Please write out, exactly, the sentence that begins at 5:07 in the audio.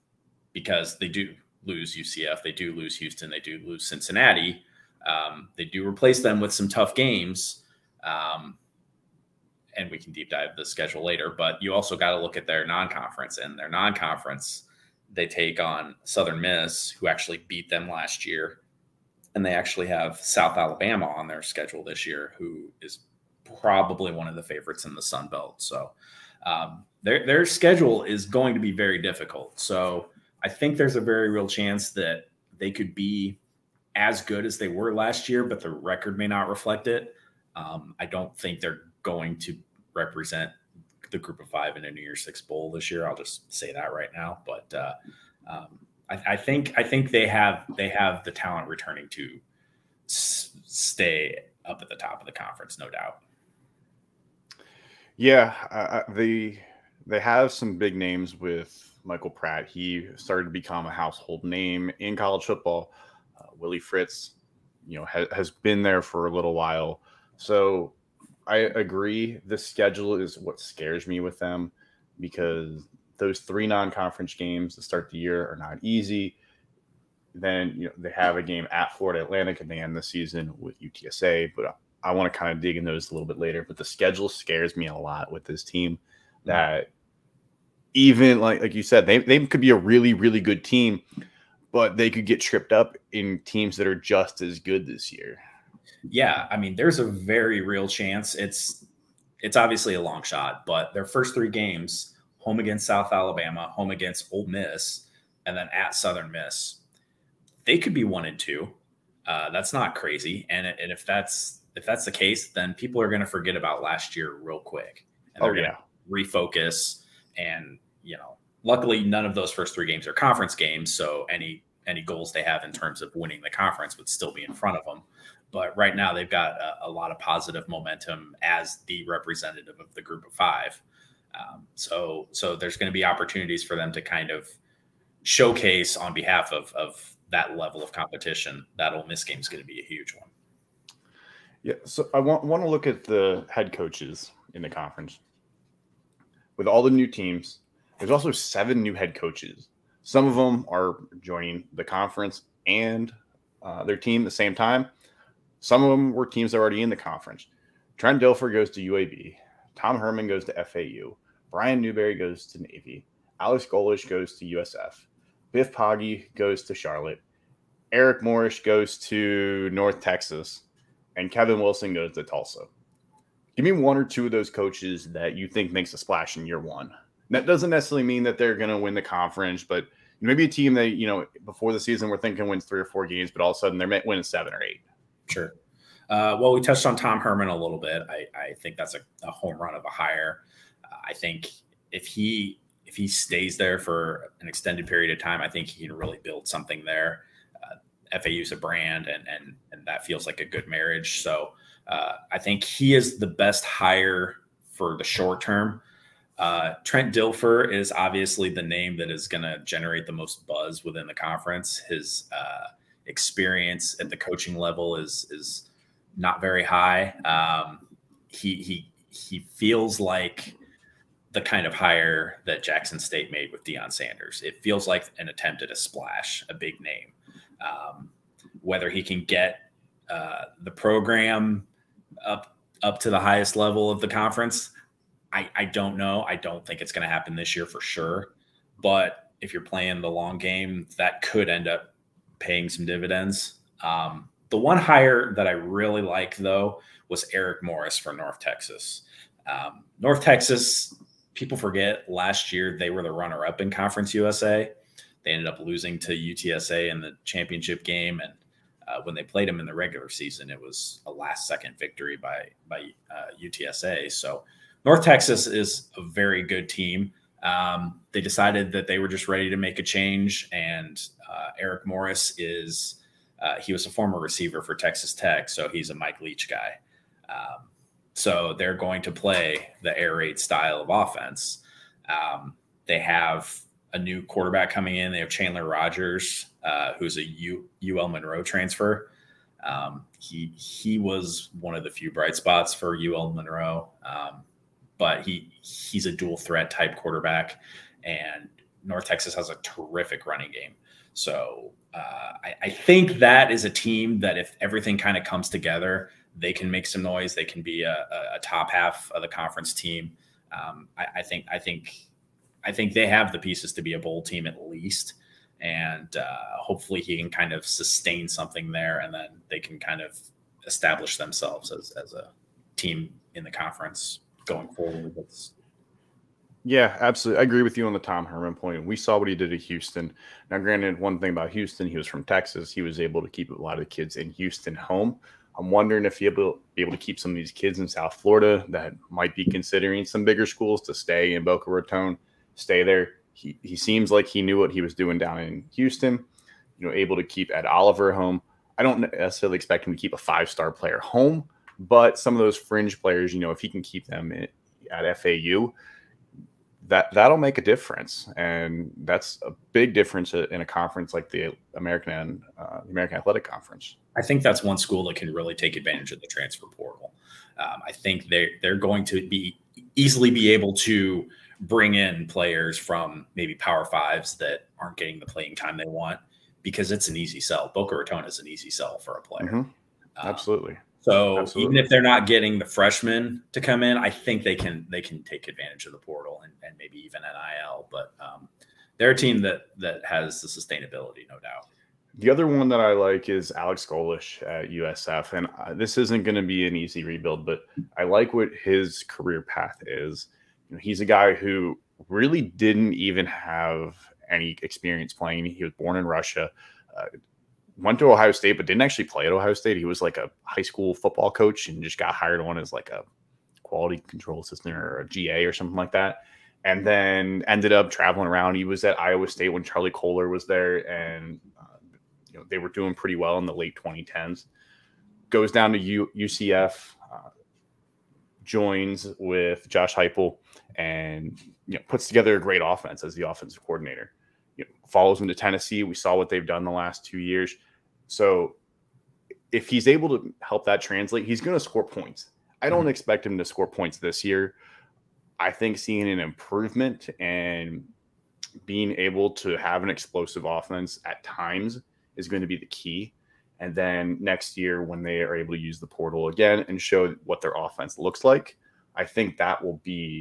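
They can be a, a top half of the conference team.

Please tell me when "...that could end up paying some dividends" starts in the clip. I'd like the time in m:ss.
4:00.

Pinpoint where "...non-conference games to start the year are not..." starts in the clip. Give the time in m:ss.
1:13.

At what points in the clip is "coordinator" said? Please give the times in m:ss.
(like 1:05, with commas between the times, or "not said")
7:13.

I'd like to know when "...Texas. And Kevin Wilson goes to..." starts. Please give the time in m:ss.
2:49.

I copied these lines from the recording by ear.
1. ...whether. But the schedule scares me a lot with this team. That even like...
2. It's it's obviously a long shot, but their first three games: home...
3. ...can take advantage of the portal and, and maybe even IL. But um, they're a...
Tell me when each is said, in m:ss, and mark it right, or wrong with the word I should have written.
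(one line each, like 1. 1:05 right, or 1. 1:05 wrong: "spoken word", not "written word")
1. 1:23 wrong: "later", not "whether"
2. 1:38 right
3. 6:25 right.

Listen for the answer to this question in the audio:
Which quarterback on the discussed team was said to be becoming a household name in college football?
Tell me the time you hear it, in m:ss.
0:59.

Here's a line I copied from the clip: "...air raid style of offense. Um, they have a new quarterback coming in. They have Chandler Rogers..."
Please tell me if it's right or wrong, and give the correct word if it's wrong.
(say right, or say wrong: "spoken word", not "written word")
right.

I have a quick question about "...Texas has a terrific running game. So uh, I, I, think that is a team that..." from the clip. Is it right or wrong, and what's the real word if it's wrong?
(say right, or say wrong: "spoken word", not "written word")
right.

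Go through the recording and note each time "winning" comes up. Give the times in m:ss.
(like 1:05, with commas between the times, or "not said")
2:03, 3:04.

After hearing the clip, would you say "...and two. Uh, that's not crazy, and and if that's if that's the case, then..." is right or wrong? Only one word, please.
right.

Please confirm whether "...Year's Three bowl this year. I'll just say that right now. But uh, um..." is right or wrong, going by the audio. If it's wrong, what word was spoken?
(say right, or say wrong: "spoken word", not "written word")
wrong: "Six", not "Three".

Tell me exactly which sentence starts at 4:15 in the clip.
They ended up losing to UTSA in the championship game.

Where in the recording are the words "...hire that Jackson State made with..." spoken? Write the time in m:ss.
3:41.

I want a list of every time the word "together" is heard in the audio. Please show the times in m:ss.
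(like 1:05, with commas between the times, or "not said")
5:05, 7:12.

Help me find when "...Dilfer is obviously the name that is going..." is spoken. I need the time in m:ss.
3:27.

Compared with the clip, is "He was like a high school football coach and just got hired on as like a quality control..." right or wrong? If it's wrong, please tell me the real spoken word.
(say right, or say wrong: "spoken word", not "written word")
right.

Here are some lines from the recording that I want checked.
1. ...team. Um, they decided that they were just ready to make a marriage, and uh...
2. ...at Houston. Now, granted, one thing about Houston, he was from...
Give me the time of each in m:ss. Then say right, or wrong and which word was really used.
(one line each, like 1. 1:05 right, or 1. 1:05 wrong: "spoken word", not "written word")
1. 4:26 wrong: "change", not "marriage"
2. 5:29 right.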